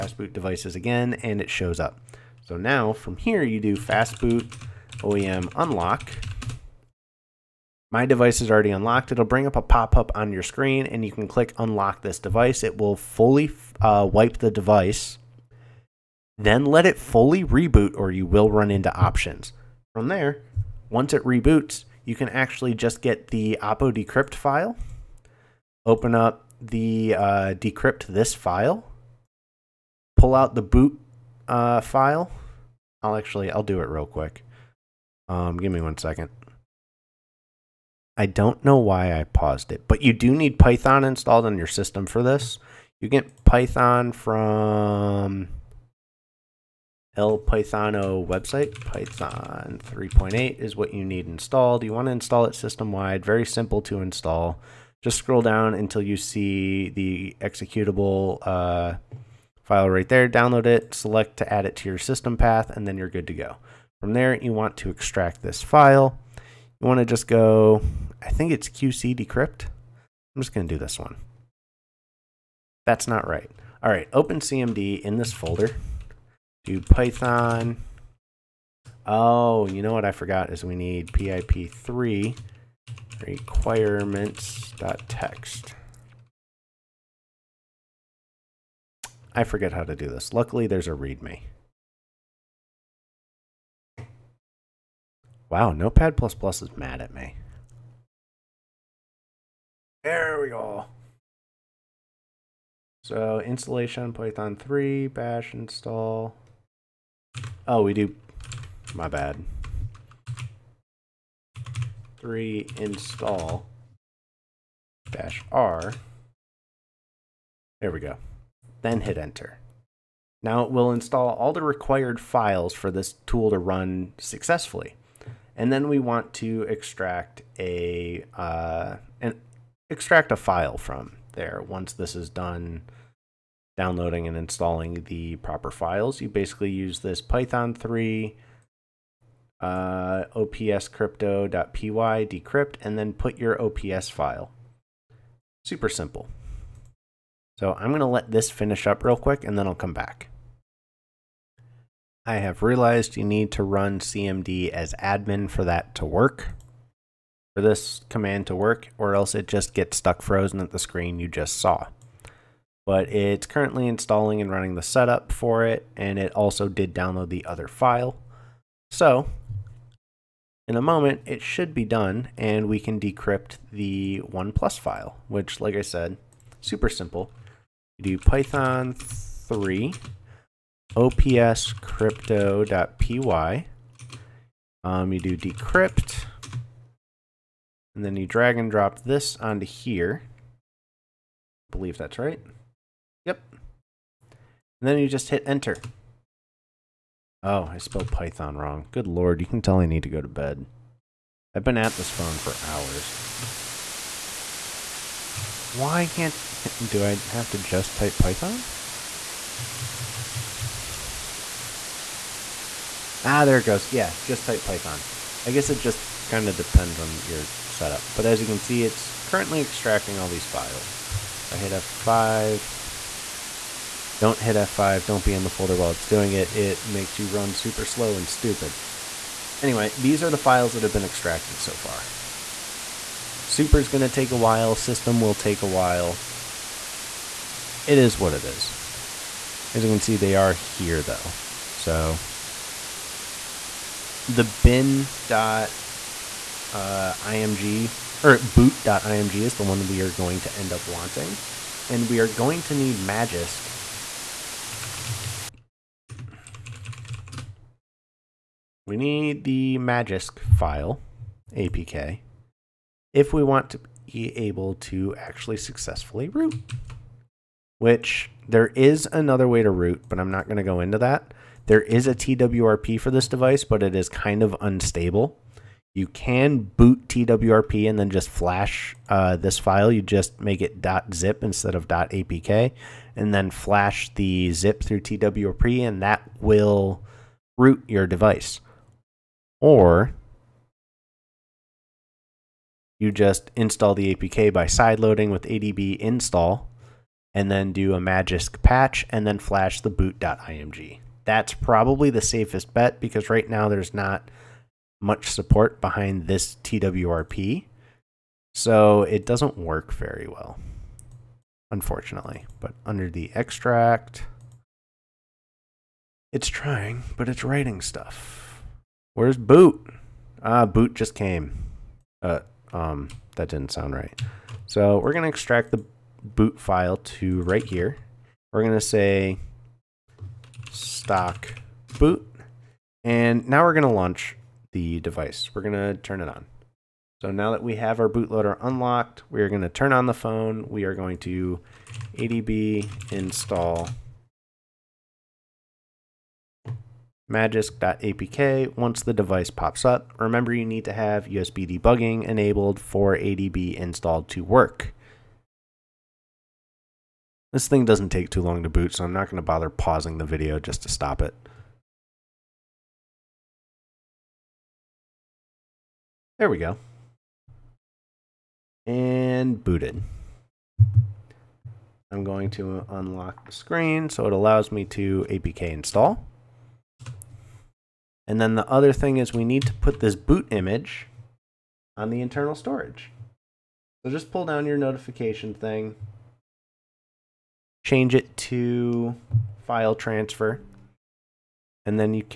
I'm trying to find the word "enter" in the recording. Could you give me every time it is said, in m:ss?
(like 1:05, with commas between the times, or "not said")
1:59, 3:15.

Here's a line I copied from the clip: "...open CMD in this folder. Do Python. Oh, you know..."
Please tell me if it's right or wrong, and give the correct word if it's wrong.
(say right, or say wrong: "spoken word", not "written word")
right.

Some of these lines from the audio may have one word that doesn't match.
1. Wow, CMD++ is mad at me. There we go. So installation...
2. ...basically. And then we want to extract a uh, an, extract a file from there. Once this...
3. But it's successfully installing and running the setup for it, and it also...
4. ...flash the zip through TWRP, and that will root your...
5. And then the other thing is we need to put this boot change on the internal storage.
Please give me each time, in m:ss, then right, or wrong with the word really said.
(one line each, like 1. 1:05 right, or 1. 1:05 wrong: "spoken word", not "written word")
1. 1:35 wrong: "Notepad", not "CMD"
2. 2:04 wrong: "successfully", not "basically"
3. 2:42 wrong: "currently", not "successfully"
4. 4:43 right
5. 6:18 wrong: "image", not "change".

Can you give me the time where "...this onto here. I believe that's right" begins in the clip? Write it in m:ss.
3:09.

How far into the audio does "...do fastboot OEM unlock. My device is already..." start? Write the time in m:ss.
0:03.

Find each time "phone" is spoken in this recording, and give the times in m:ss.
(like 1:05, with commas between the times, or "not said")
3:22, 5:40.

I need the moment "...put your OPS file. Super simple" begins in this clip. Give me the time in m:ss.
2:23.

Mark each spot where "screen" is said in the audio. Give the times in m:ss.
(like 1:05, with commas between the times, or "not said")
0:10, 2:40, 6:13.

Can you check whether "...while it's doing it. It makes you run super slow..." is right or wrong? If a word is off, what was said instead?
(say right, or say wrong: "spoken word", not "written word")
right.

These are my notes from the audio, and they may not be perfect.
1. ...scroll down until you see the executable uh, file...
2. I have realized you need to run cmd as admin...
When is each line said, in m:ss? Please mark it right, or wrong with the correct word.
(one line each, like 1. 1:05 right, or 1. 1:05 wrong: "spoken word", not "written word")
1. 0:55 right
2. 2:32 right.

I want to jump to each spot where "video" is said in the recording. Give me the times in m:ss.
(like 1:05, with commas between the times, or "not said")
6:00.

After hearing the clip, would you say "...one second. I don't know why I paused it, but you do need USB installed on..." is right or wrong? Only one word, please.
wrong.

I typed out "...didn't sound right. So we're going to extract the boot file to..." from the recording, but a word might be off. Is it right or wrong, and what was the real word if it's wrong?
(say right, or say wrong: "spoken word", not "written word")
right.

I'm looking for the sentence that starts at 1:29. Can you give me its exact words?
I forget how to do this.